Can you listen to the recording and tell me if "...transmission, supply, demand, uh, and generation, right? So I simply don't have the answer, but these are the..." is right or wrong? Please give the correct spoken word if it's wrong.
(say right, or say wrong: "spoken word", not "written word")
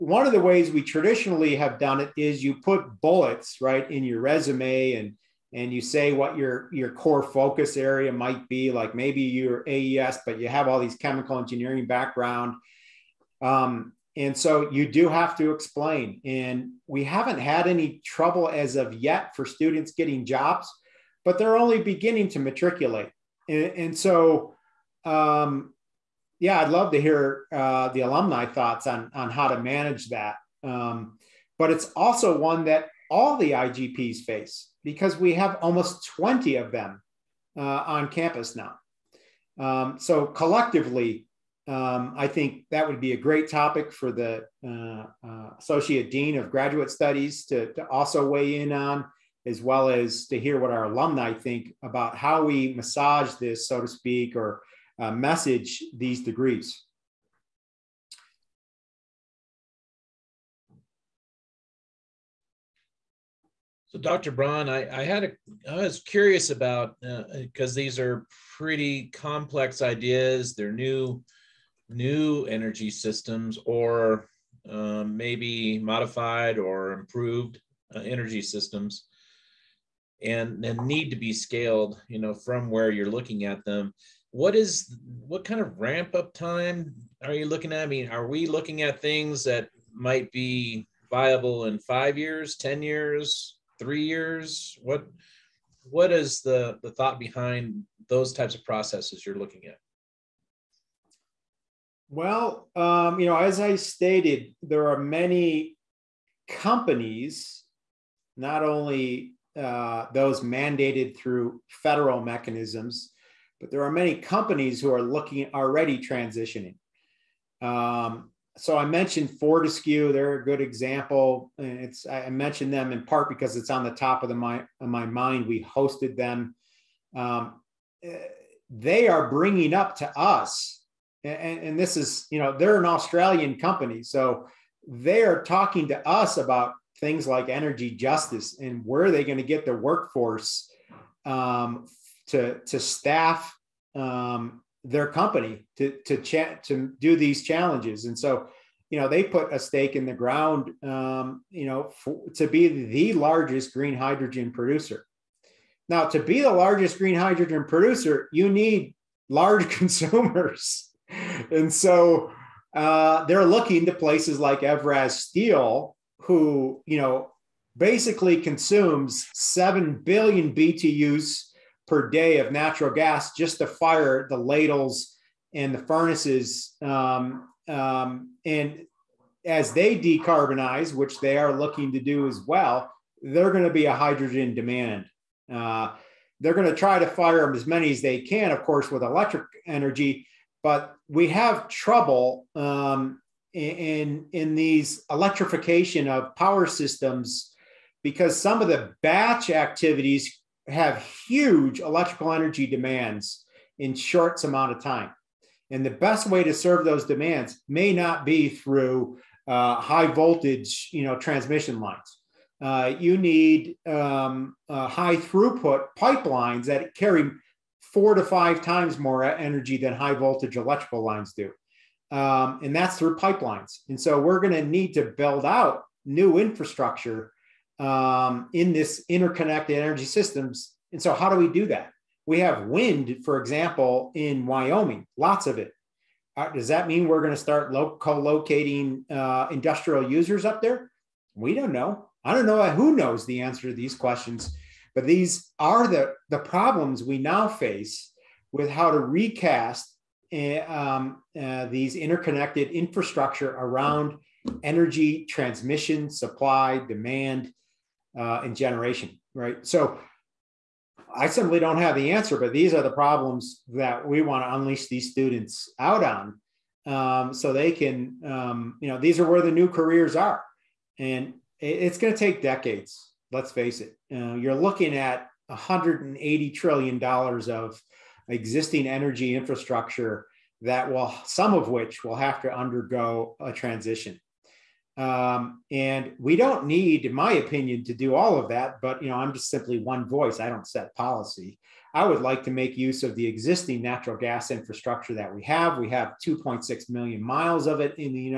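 right.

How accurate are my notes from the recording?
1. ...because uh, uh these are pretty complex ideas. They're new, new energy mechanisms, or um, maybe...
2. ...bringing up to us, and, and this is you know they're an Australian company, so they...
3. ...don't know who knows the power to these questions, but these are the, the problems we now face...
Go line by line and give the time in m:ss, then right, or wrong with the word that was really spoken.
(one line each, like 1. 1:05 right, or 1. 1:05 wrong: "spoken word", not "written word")
1. 1:07 wrong: "systems", not "mechanisms"
2. 2:09 right
3. 4:02 wrong: "answer", not "power".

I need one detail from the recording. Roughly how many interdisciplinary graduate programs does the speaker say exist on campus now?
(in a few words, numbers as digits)
almost 20.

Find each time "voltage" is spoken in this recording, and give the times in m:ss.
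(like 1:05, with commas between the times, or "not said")
3:30, 3:40.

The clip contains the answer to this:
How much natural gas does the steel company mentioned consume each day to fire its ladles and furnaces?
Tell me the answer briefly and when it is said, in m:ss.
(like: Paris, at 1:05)
7 billion BTUs, at 2:49.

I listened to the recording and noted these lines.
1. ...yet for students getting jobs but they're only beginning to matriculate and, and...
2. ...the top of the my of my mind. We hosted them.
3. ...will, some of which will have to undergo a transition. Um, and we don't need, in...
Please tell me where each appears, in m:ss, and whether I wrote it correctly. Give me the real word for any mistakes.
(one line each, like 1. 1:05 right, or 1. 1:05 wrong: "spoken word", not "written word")
1. 0:18 right
2. 2:03 right
3. 4:40 right.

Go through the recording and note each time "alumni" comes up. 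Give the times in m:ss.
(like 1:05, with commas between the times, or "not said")
0:28, 0:50.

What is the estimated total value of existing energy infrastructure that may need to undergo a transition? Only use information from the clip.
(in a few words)
$180 trillion.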